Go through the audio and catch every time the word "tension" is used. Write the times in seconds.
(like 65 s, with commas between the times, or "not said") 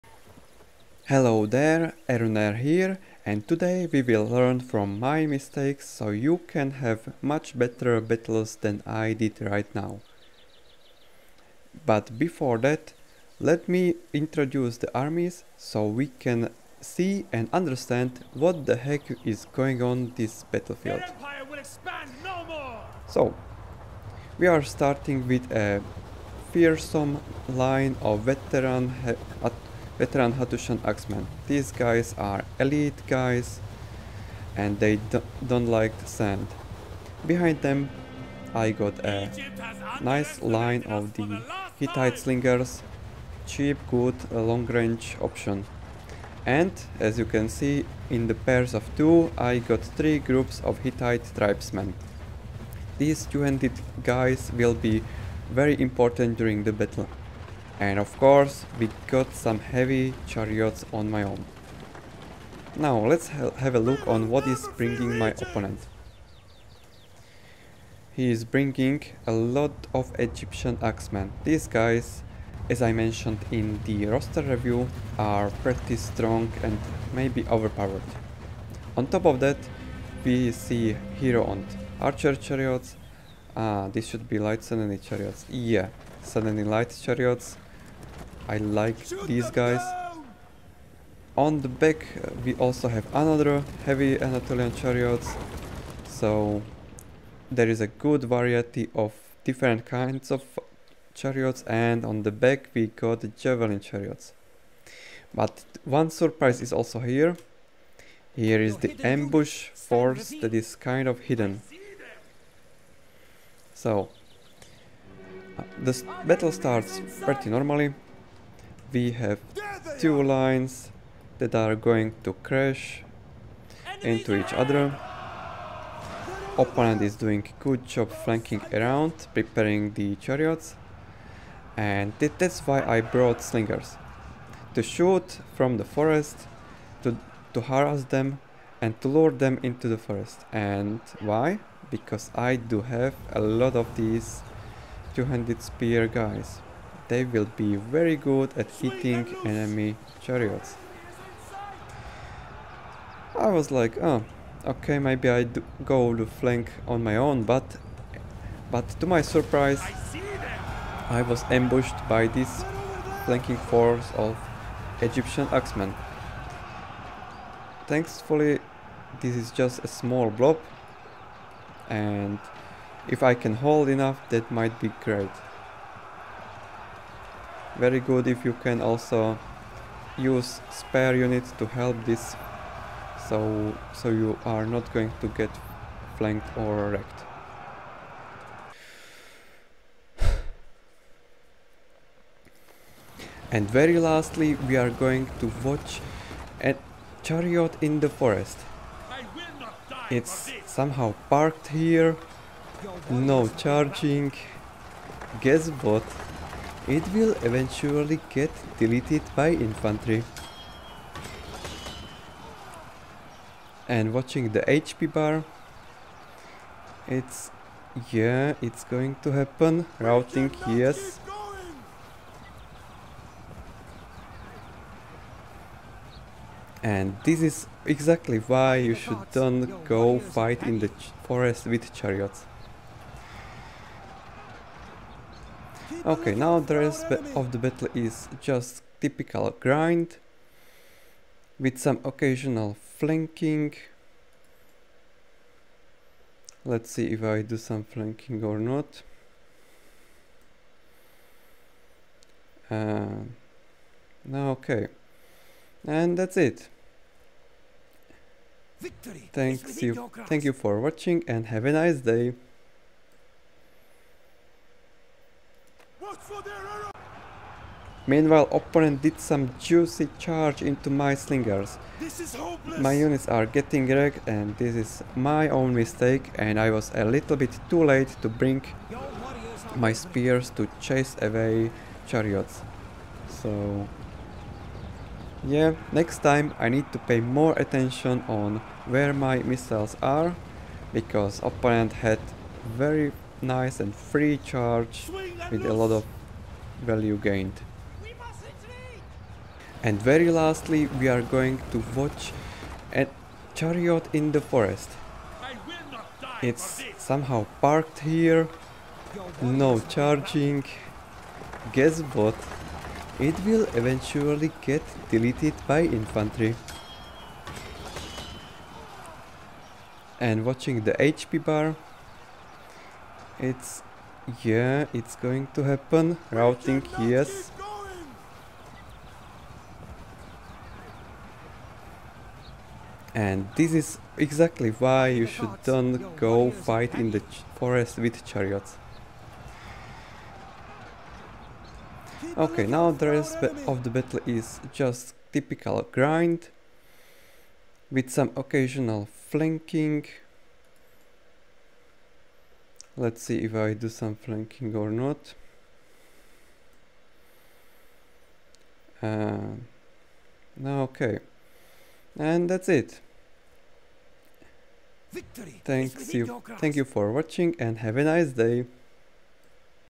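not said.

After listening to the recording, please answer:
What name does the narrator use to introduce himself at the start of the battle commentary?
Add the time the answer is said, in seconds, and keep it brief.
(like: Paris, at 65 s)
Eruner, at 2 s.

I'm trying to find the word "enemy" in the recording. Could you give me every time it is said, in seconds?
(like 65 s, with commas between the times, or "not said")
149 s.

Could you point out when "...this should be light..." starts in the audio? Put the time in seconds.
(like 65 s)
83 s.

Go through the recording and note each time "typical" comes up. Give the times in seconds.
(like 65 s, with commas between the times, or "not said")
239 s, 345 s.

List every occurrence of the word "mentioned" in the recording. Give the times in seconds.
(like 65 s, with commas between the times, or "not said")
72 s.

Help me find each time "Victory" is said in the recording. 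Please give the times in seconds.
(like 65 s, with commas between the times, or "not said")
258 s, 365 s.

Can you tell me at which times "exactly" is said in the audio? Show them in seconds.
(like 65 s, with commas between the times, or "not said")
227 s, 334 s.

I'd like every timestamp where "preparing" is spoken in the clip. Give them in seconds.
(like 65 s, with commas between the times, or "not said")
129 s.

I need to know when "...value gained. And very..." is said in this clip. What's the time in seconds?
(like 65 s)
296 s.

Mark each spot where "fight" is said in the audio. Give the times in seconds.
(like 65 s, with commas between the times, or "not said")
230 s, 336 s.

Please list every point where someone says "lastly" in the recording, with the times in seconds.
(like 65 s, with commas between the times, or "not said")
193 s, 300 s.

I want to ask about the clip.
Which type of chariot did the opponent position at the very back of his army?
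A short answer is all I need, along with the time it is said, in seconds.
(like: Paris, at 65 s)
javelin chariots, at 103 s.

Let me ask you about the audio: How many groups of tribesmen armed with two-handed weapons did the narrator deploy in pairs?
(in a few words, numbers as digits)
3.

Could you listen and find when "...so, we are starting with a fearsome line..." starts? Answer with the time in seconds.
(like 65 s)
23 s.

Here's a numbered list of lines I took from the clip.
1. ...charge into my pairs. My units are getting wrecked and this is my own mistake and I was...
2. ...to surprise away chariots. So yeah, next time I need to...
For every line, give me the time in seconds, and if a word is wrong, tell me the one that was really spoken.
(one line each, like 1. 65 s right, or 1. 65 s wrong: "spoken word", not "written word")
1. 270 s wrong: "slingers", not "pairs"
2. 280 s wrong: "chase", not "surprise".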